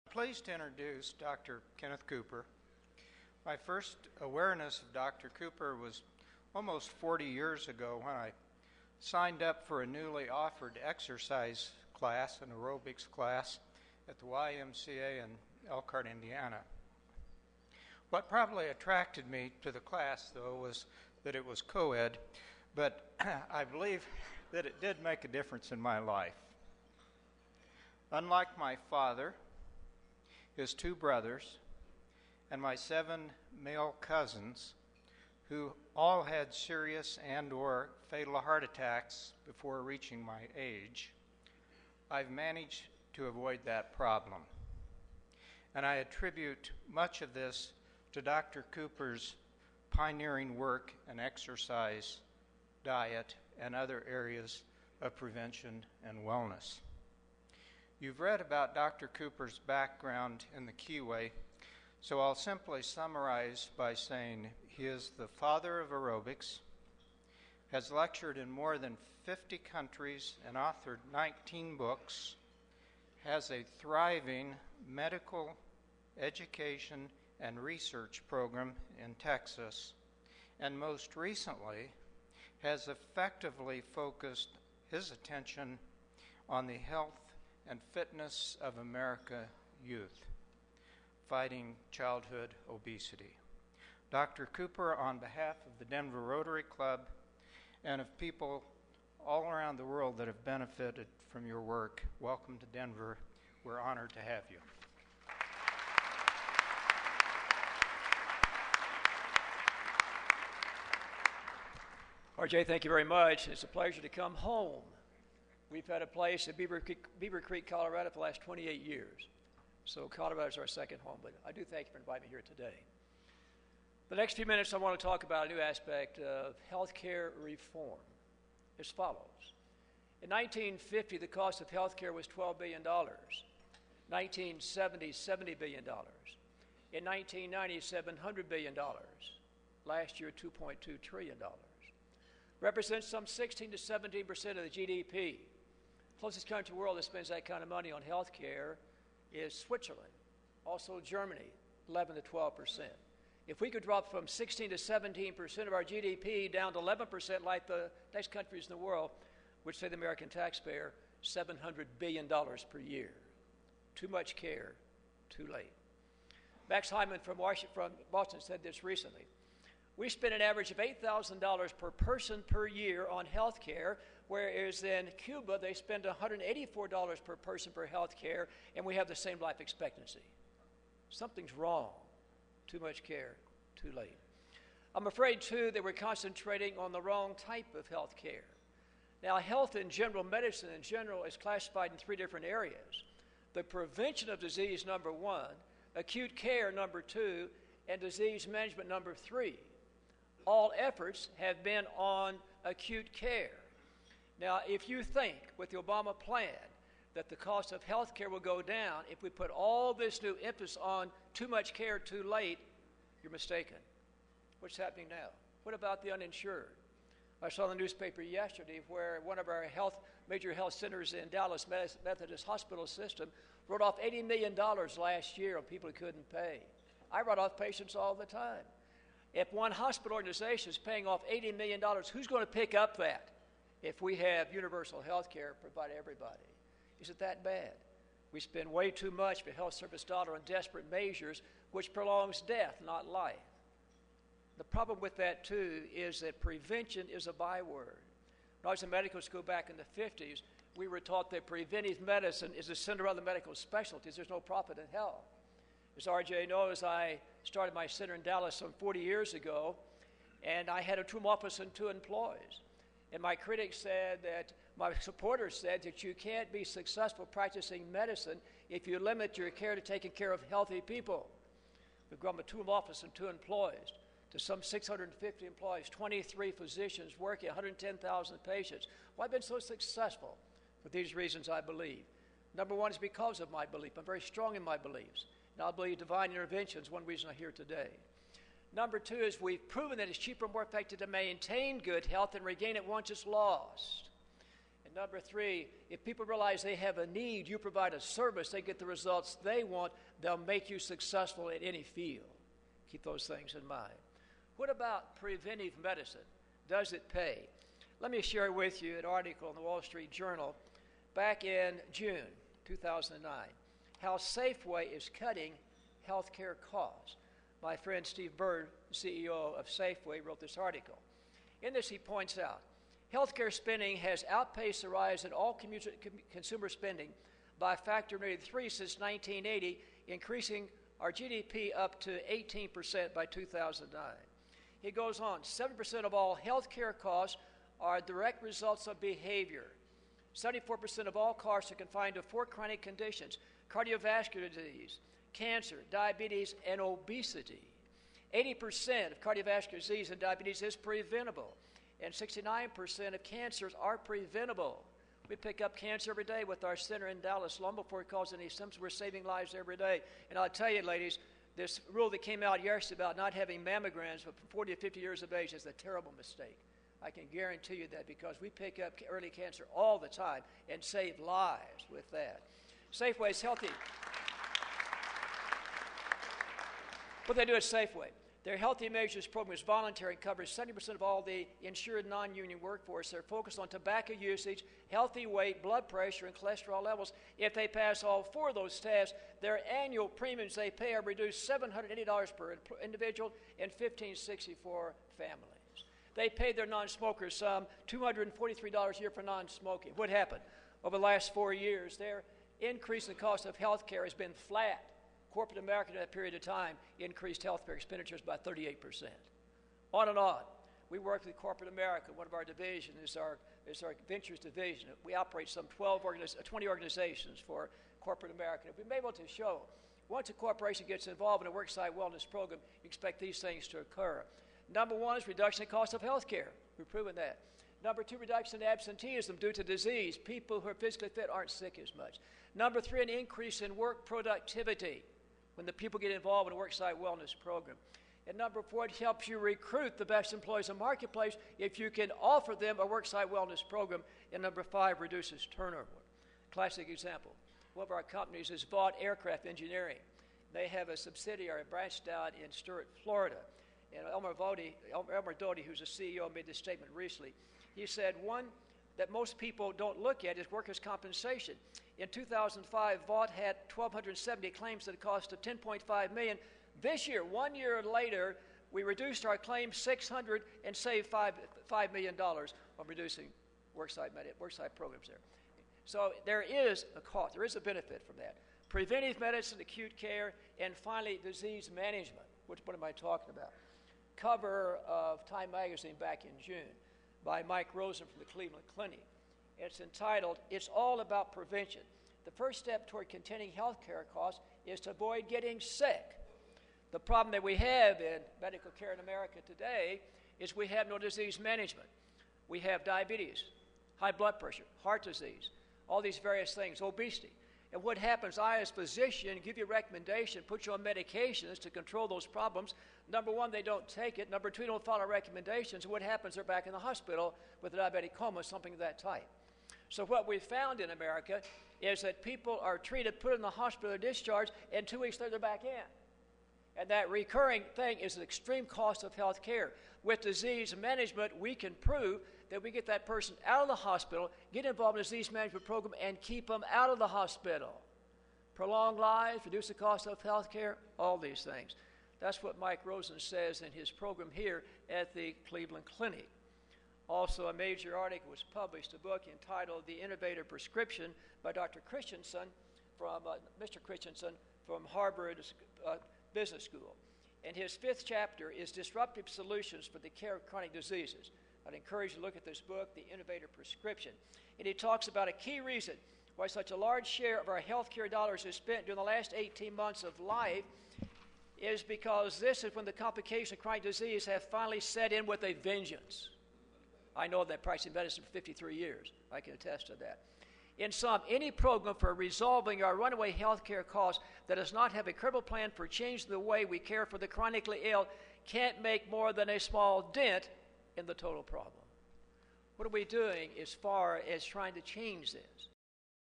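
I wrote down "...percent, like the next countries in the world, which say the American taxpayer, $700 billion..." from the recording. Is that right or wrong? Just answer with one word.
right.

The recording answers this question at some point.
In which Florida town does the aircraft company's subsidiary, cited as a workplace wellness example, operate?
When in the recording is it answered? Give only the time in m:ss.
7:32.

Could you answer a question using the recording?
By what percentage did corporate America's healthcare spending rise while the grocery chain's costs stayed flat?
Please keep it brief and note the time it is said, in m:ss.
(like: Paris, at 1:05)
38%, at 6:48.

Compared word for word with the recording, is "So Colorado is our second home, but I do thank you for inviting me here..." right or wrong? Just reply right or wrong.
right.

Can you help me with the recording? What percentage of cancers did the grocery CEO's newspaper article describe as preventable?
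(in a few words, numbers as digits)
69%.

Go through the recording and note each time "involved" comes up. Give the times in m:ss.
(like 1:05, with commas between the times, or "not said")
7:01, 7:16, 8:54.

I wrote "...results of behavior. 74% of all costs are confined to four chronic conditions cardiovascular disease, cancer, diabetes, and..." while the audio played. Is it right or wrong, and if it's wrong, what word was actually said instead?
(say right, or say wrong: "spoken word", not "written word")
right.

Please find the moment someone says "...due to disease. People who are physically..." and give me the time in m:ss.
7:09.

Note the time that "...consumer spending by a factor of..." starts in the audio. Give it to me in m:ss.
5:26.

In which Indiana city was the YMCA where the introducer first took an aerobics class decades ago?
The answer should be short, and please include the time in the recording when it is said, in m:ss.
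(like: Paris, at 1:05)
Elkhart, at 0:15.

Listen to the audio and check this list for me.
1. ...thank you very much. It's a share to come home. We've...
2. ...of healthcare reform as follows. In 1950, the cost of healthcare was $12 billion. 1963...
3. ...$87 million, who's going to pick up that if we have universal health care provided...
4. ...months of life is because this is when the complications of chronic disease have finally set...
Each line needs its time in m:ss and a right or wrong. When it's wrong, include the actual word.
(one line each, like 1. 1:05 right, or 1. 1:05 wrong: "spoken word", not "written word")
1. 1:52 wrong: "pleasure", not "share"
2. 2:06 wrong: "1970", not "1963"
3. 3:51 wrong: "80", not "87"
4. 9:29 right.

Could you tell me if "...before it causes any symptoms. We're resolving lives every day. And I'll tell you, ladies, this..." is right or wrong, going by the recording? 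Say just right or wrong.
wrong.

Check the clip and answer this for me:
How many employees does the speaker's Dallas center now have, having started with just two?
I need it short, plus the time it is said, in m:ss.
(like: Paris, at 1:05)
650, at 4:34.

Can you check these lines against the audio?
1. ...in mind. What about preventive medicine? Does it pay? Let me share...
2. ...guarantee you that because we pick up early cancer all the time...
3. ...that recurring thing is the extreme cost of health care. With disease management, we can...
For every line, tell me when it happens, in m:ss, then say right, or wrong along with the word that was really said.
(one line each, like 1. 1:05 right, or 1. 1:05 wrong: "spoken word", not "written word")
1. 5:03 right
2. 6:07 right
3. 8:46 right.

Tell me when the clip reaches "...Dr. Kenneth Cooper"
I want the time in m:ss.
0:01.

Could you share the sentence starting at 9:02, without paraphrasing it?
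That's what Mike Roizen says in his program here at the Cleveland Clinic.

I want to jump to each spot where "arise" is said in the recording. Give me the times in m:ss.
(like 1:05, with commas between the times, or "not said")
not said.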